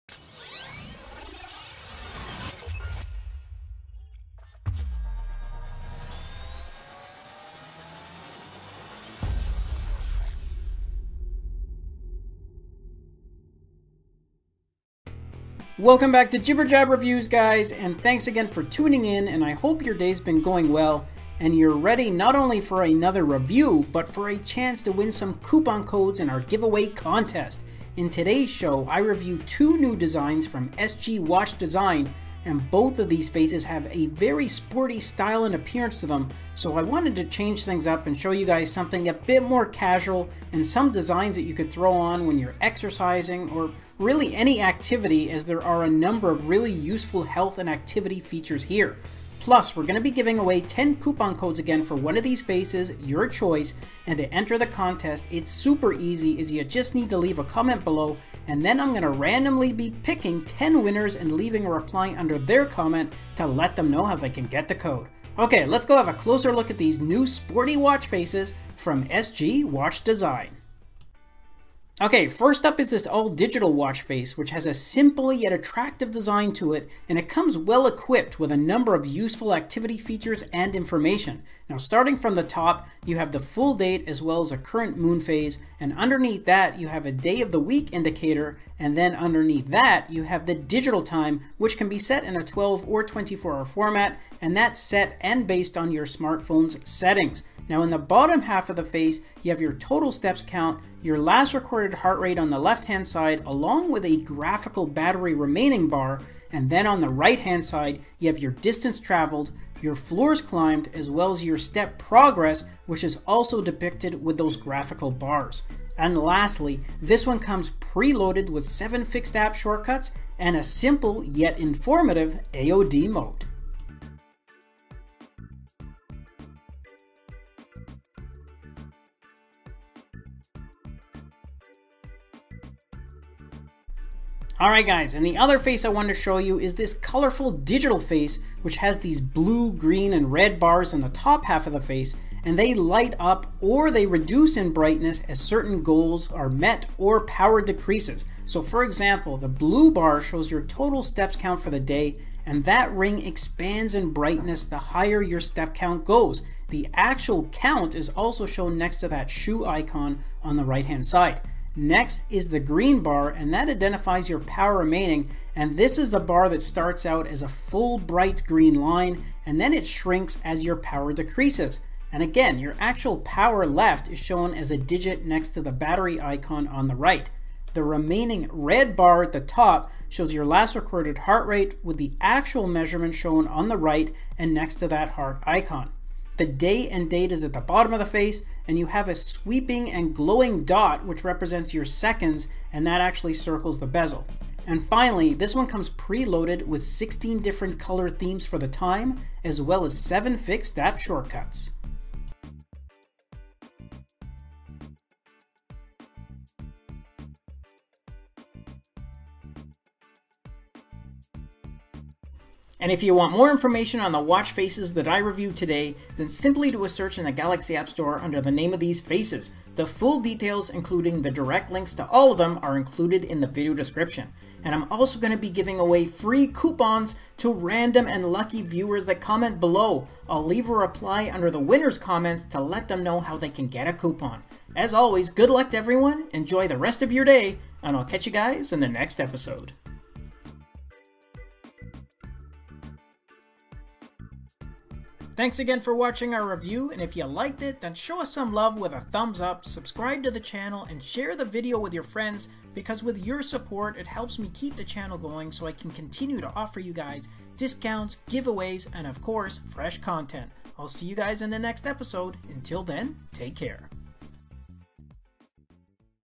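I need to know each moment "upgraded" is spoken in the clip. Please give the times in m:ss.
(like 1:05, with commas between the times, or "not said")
not said.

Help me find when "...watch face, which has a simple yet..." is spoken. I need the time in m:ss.
1:13.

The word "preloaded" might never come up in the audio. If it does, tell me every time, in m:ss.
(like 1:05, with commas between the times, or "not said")
1:57, 3:15.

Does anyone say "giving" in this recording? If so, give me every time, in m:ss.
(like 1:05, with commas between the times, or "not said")
0:50, 3:45.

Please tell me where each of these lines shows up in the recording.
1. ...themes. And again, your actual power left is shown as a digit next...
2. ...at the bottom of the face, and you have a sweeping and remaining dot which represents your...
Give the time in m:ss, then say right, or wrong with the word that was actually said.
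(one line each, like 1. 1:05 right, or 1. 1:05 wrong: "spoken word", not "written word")
1. 2:51 wrong: "decreases", not "themes"
2. 3:07 wrong: "glowing", not "remaining".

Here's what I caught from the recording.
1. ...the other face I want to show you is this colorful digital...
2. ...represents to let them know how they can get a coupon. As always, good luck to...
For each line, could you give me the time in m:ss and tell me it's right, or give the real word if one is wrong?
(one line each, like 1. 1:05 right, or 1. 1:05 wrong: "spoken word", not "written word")
1. 2:15 right
2. 3:51 wrong: "comments", not "represents".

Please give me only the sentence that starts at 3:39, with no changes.
The full details, including the direct links to all of them, are included in the video description.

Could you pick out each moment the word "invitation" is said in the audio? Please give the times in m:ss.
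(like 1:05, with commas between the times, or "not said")
not said.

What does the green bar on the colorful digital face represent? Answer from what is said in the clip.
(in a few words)
power remaining.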